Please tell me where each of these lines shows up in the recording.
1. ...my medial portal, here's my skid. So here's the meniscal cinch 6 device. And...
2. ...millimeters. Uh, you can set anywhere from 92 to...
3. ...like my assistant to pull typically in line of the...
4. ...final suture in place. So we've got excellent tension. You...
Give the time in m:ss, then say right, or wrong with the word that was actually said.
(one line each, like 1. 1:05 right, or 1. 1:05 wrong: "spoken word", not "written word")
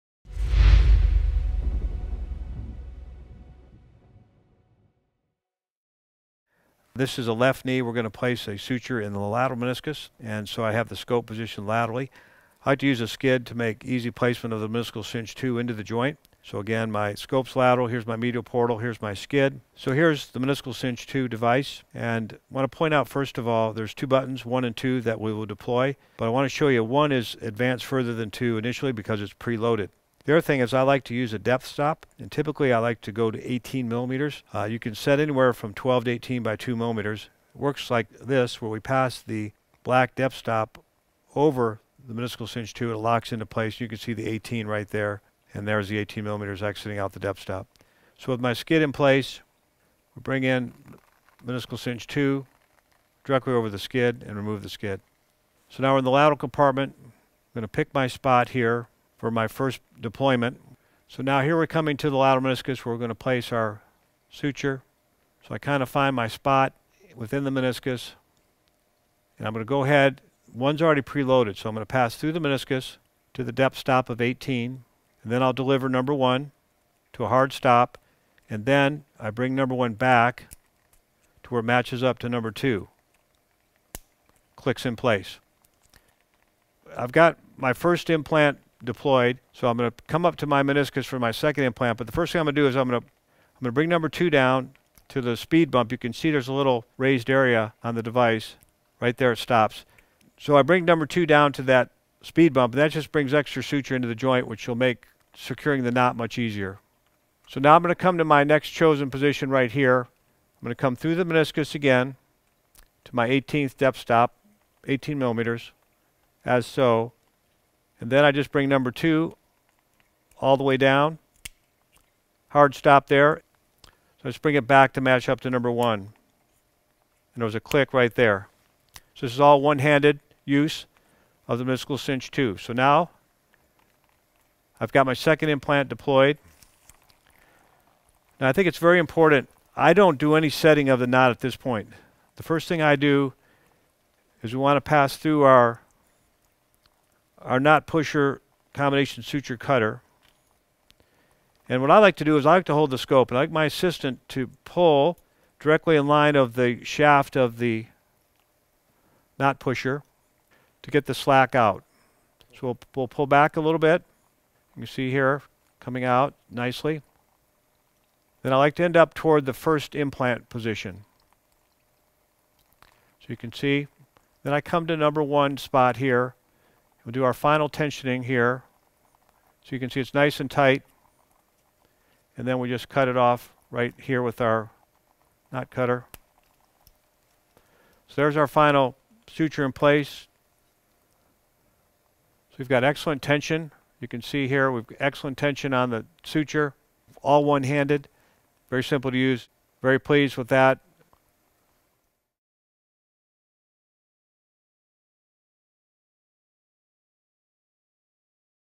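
1. 0:18 wrong: "2", not "6"
2. 0:33 wrong: "12", not "92"
3. 2:33 wrong: "directly", not "typically"
4. 3:08 right.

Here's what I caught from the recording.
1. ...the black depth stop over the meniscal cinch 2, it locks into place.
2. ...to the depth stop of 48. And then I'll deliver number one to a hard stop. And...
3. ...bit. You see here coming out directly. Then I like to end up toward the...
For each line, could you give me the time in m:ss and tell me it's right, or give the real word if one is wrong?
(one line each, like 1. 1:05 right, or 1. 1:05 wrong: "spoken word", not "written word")
1. 0:39 right
2. 1:13 wrong: "18", not "48"
3. 2:43 wrong: "nicely", not "directly".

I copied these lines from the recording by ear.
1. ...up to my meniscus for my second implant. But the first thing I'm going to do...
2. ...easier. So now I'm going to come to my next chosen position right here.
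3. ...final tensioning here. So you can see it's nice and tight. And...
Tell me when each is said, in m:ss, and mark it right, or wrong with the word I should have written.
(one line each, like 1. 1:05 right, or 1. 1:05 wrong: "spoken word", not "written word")
1. 1:30 right
2. 1:46 right
3. 2:57 right.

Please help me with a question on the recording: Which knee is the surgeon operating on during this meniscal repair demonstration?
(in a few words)
Left.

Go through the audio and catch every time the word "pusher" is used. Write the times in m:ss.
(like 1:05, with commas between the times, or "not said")
2:27, 2:39.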